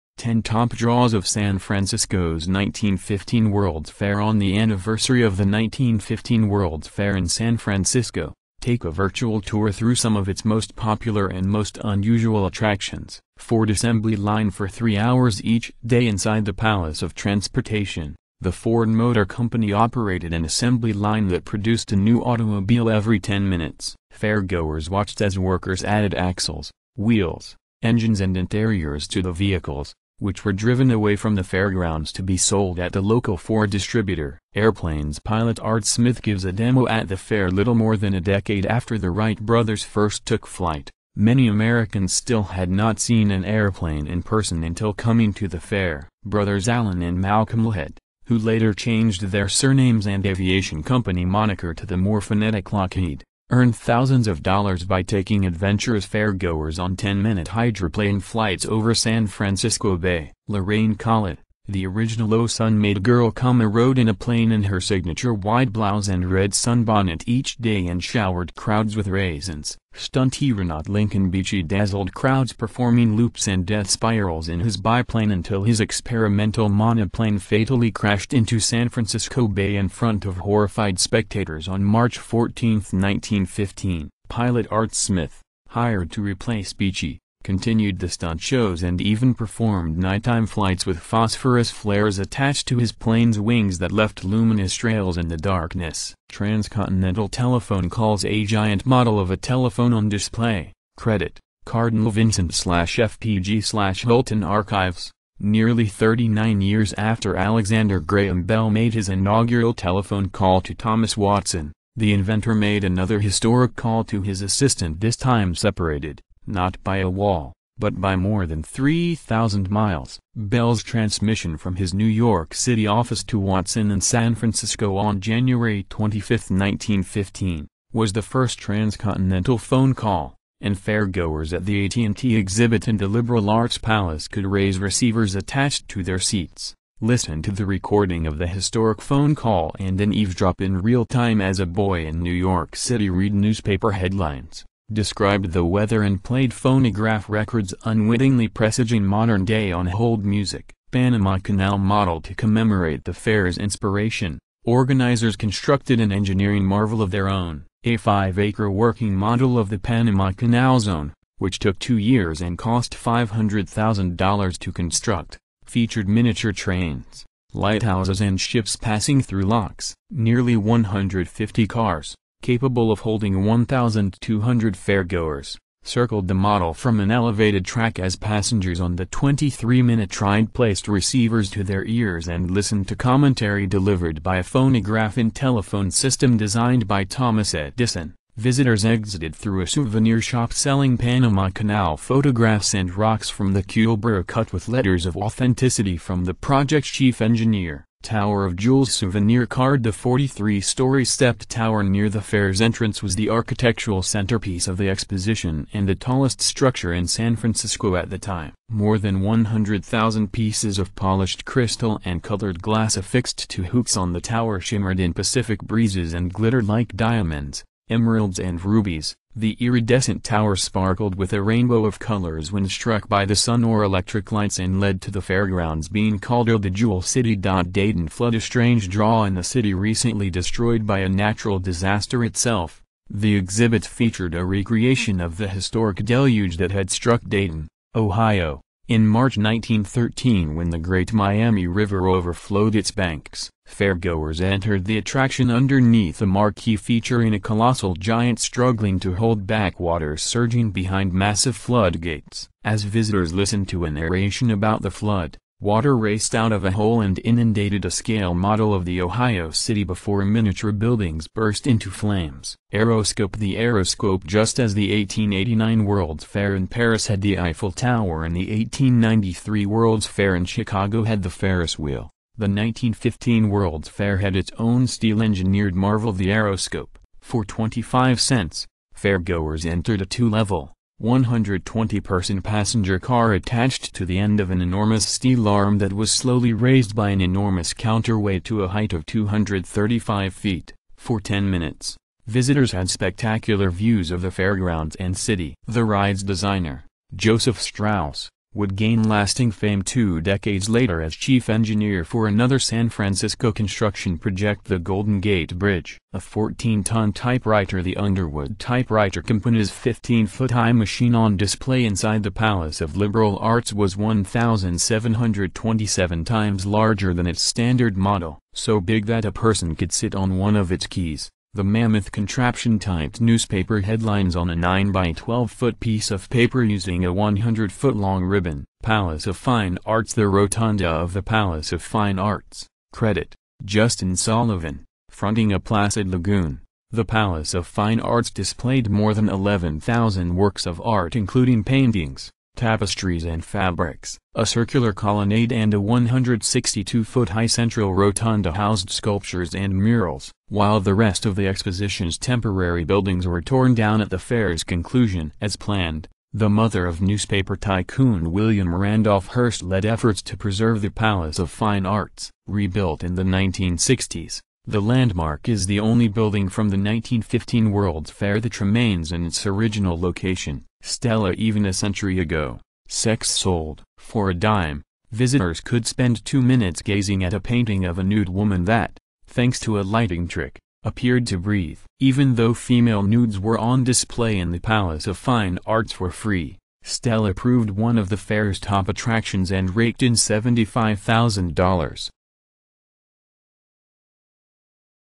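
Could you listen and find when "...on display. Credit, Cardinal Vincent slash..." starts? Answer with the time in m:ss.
1:39.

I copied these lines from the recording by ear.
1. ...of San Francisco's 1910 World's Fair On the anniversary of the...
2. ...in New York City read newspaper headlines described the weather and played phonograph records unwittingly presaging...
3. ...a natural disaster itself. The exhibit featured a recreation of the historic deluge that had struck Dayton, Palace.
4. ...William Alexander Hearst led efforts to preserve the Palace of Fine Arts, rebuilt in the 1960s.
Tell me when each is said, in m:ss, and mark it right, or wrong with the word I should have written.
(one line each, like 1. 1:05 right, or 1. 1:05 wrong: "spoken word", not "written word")
1. 0:01 wrong: "1915", not "1910"
2. 2:22 right
3. 3:50 wrong: "Ohio", not "Palace"
4. 5:58 wrong: "Randolph", not "Alexander".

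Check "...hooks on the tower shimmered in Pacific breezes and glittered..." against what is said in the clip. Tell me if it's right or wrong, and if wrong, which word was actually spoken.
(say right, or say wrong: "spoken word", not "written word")
right.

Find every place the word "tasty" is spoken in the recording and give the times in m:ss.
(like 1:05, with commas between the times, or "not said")
not said.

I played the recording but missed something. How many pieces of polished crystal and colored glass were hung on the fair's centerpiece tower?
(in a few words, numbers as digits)
100,000.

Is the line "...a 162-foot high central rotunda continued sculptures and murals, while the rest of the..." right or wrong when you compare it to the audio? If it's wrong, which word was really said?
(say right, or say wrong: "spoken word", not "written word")
wrong: "housed", not "continued".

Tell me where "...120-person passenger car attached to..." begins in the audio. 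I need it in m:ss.
4:41.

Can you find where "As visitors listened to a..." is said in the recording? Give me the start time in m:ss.
4:12.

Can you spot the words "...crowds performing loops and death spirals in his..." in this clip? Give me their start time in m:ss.
1:12.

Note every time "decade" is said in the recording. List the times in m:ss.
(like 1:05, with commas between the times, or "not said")
0:38, 5:00.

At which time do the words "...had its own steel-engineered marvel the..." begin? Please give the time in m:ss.
4:34.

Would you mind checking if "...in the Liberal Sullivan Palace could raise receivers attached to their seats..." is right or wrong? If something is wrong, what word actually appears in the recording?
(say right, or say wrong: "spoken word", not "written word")
wrong: "Arts", not "Sullivan".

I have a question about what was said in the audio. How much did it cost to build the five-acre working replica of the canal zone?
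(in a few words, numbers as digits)
$500,000.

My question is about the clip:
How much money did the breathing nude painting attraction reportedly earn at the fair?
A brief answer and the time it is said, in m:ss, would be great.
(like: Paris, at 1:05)
$75,000, at 6:30.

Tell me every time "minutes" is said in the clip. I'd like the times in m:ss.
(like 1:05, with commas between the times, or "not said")
0:23, 0:56, 2:59, 4:51, 6:16.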